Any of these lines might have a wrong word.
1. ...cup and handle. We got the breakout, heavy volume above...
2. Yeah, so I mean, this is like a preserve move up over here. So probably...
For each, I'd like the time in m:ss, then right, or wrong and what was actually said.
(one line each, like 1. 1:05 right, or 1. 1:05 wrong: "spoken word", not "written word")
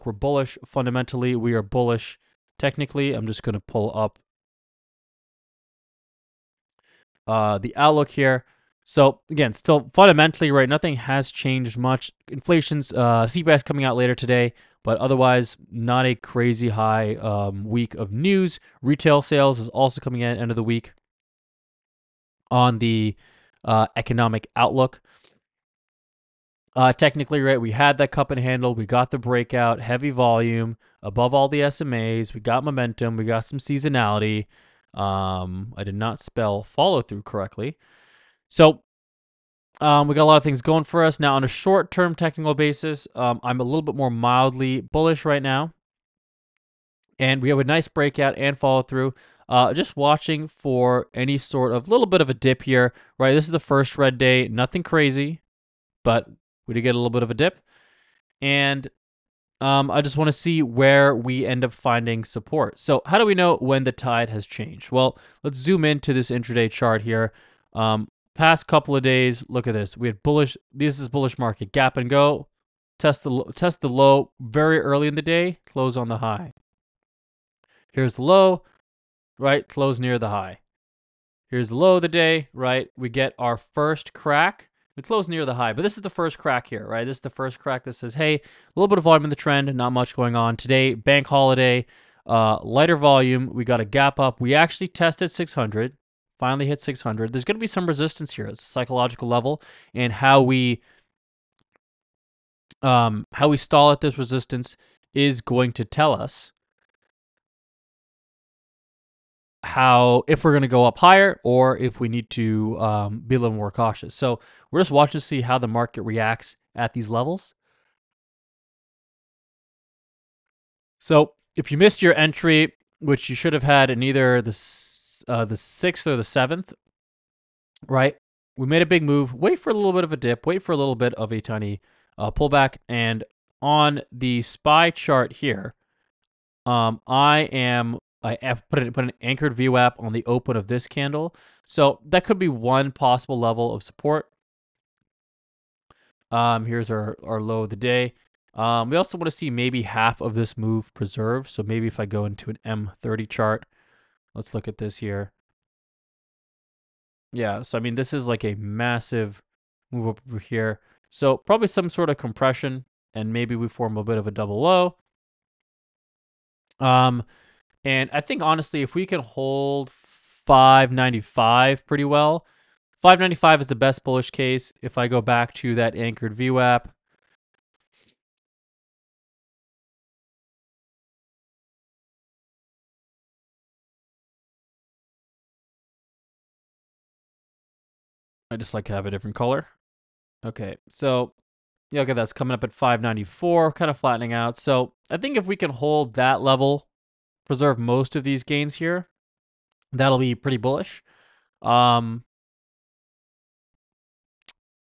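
1. 0:28 right
2. 2:37 wrong: "massive", not "preserve".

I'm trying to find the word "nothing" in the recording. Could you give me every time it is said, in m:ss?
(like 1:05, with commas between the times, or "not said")
0:10, 0:54.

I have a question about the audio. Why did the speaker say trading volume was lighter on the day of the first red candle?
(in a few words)
Bank holiday.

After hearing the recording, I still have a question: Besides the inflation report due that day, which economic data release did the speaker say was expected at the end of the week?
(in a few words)
Retail sales.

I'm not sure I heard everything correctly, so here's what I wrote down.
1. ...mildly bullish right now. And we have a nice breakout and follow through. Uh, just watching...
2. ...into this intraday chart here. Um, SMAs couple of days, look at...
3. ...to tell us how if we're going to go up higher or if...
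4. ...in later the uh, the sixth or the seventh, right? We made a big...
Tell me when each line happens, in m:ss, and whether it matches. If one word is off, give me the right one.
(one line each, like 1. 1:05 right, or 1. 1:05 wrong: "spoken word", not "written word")
1. 0:44 right
2. 1:05 wrong: "Past", not "SMAs"
3. 1:45 right
4. 2:03 wrong: "either", not "later".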